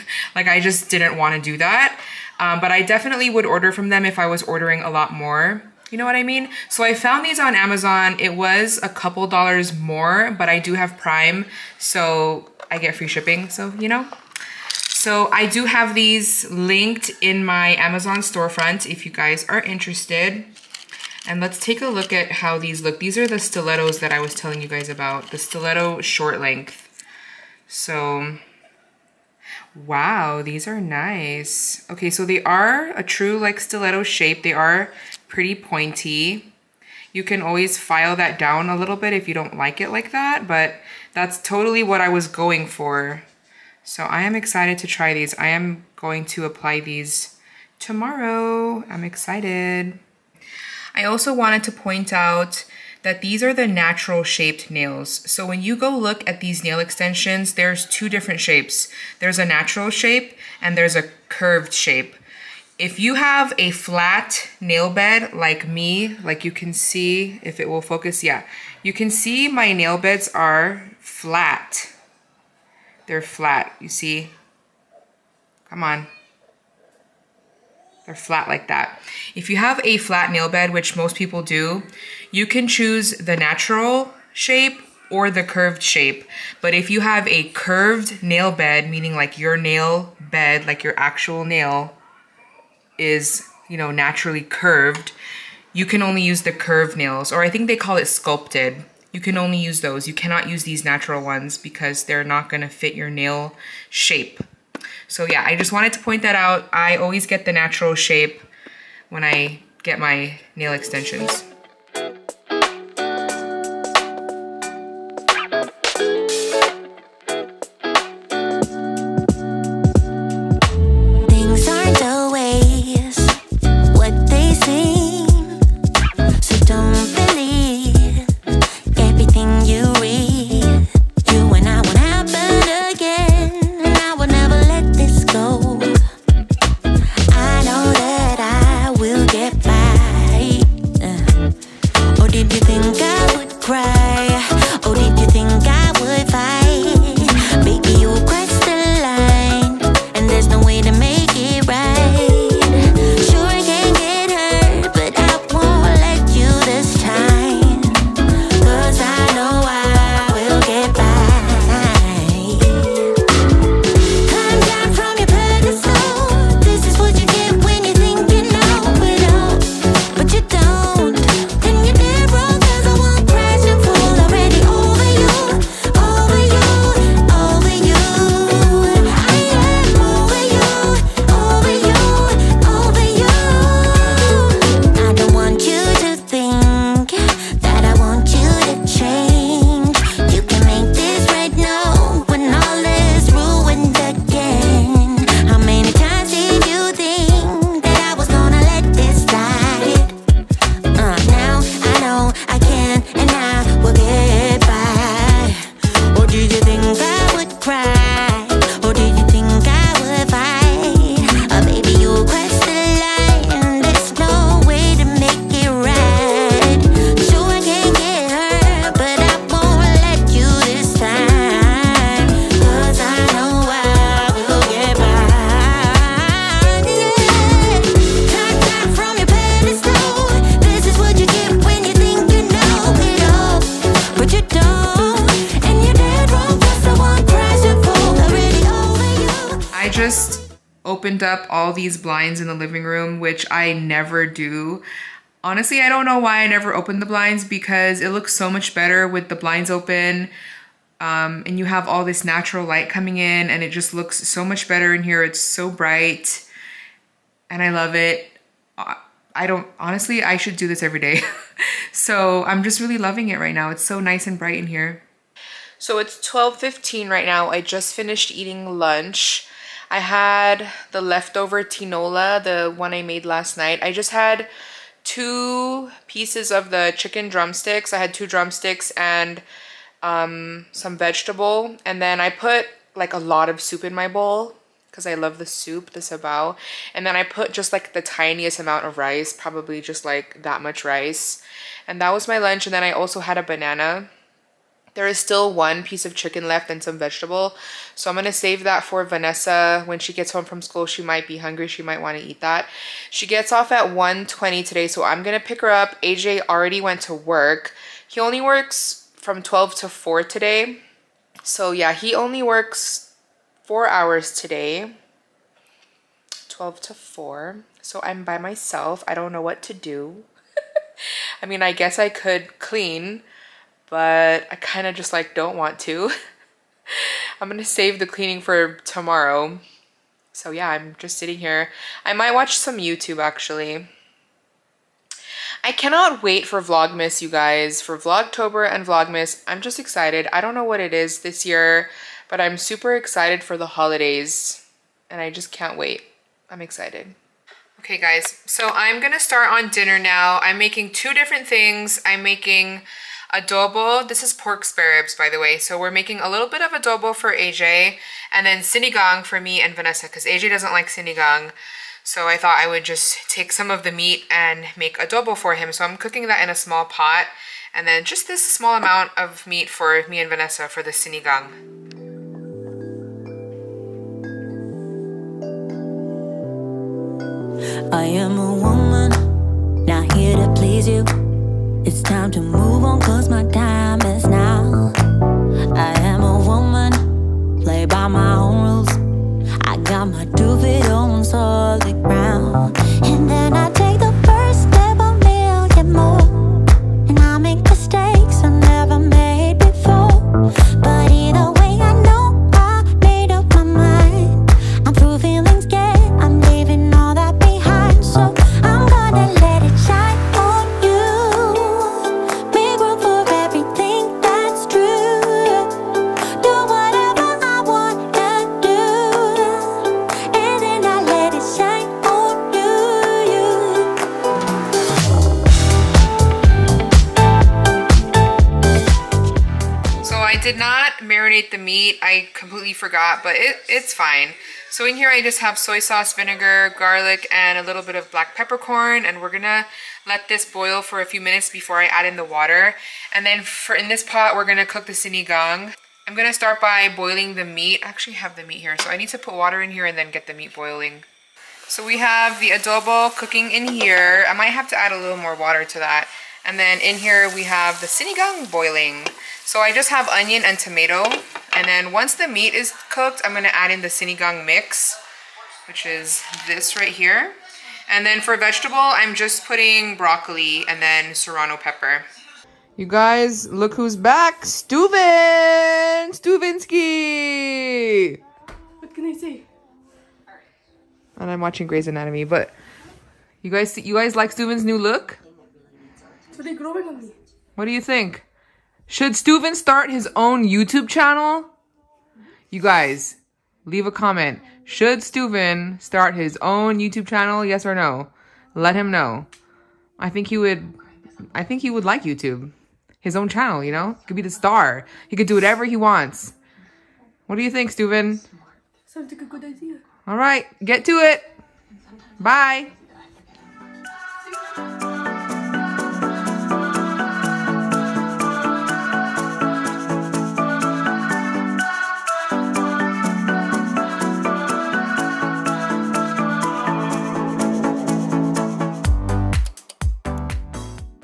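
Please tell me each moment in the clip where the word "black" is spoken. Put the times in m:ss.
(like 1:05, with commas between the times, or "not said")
7:18.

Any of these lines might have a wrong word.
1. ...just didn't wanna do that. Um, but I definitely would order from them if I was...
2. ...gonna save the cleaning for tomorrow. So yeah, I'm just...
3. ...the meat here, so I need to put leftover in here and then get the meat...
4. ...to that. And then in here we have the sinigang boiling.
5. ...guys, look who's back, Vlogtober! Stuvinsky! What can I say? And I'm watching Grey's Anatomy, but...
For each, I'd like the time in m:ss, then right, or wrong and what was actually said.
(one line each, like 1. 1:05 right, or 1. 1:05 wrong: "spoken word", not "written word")
1. 0:00 right
2. 5:27 right
3. 7:28 wrong: "water", not "leftover"
4. 7:35 right
5. 7:52 wrong: "Stuven", not "Vlogtober".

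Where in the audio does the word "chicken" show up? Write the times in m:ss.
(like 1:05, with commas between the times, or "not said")
4:36, 4:56.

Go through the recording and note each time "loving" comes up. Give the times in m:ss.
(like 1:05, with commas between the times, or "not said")
4:22.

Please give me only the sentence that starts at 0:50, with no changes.
I also wanted to point out that these are the natural shaped nails.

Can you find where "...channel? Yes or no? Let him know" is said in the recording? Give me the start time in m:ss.
8:17.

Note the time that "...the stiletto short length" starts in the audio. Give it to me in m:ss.
0:25.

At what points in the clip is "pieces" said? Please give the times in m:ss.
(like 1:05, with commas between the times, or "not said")
4:36, 4:55.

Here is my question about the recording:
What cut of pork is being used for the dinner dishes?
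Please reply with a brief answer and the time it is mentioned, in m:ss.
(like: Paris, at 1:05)
pork spare ribs, at 5:54.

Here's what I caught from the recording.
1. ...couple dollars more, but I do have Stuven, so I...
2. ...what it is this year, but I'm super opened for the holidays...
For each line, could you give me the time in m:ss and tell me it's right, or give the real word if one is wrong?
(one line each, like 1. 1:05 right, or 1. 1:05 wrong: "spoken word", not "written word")
1. 0:08 wrong: "Prime", not "Stuven"
2. 5:40 wrong: "excited", not "opened".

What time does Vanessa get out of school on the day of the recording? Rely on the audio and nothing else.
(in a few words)
1:20.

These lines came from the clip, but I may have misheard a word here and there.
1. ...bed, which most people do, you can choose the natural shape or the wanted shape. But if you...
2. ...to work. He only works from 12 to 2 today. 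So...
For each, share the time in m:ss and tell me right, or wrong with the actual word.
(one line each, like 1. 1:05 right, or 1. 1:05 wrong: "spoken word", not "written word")
1. 1:20 wrong: "curved", not "wanted"
2. 5:07 wrong: "4", not "2".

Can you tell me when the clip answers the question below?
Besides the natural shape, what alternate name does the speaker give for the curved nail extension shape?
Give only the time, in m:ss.
1:37.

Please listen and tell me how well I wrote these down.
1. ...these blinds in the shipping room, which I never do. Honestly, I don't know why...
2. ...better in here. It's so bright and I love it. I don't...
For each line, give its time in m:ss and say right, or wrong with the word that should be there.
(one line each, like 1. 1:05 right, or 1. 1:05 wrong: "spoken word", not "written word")
1. 4:01 wrong: "living", not "shipping"
2. 4:14 right.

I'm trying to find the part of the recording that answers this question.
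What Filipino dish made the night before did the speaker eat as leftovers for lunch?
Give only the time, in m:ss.
4:31.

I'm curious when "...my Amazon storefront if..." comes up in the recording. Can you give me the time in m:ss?
0:17.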